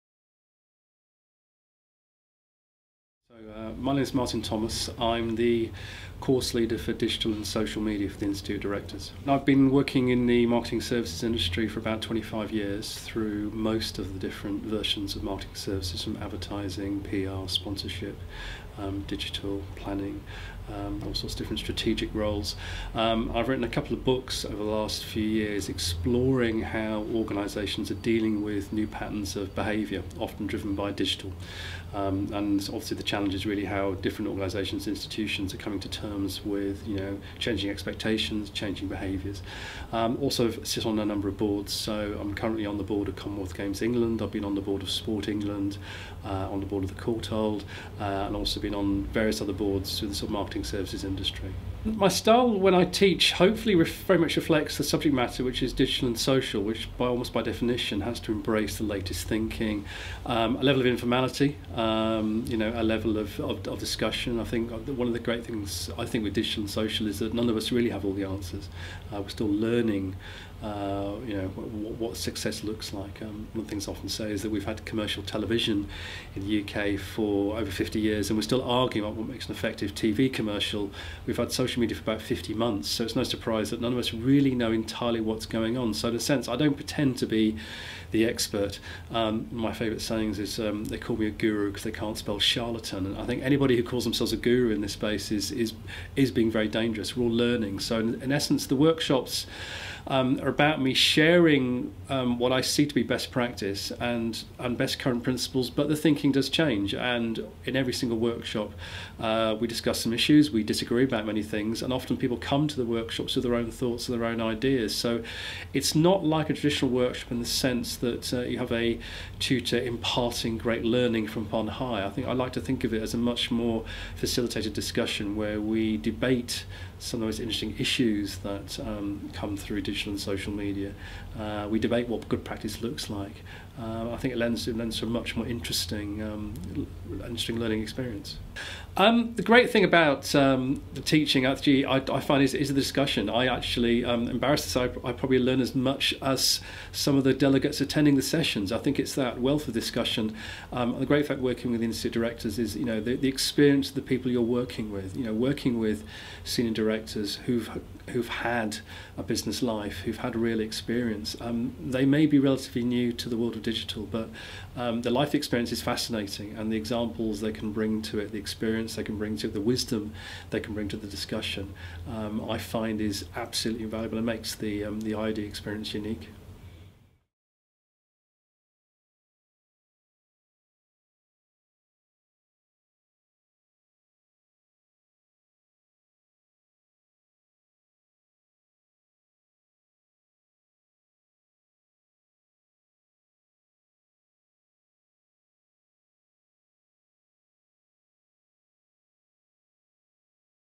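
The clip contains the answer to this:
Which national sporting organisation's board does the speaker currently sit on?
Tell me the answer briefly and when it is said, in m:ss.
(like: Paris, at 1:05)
Commonwealth Games England, at 0:43.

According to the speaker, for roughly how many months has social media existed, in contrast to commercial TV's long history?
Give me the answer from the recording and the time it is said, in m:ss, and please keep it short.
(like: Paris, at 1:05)
50 months, at 1:22.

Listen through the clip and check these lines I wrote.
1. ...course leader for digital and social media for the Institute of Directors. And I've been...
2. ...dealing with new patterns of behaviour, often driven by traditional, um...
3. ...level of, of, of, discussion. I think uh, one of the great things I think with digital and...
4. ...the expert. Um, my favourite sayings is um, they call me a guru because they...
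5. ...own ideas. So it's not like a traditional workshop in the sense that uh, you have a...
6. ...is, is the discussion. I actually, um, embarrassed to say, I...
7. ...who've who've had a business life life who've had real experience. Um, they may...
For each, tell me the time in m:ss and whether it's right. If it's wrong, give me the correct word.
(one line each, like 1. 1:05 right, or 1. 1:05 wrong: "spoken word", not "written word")
1. 0:06 right
2. 0:27 wrong: "digital", not "traditional"
3. 1:03 right
4. 1:28 right
5. 1:54 right
6. 2:22 right
7. 2:37 right.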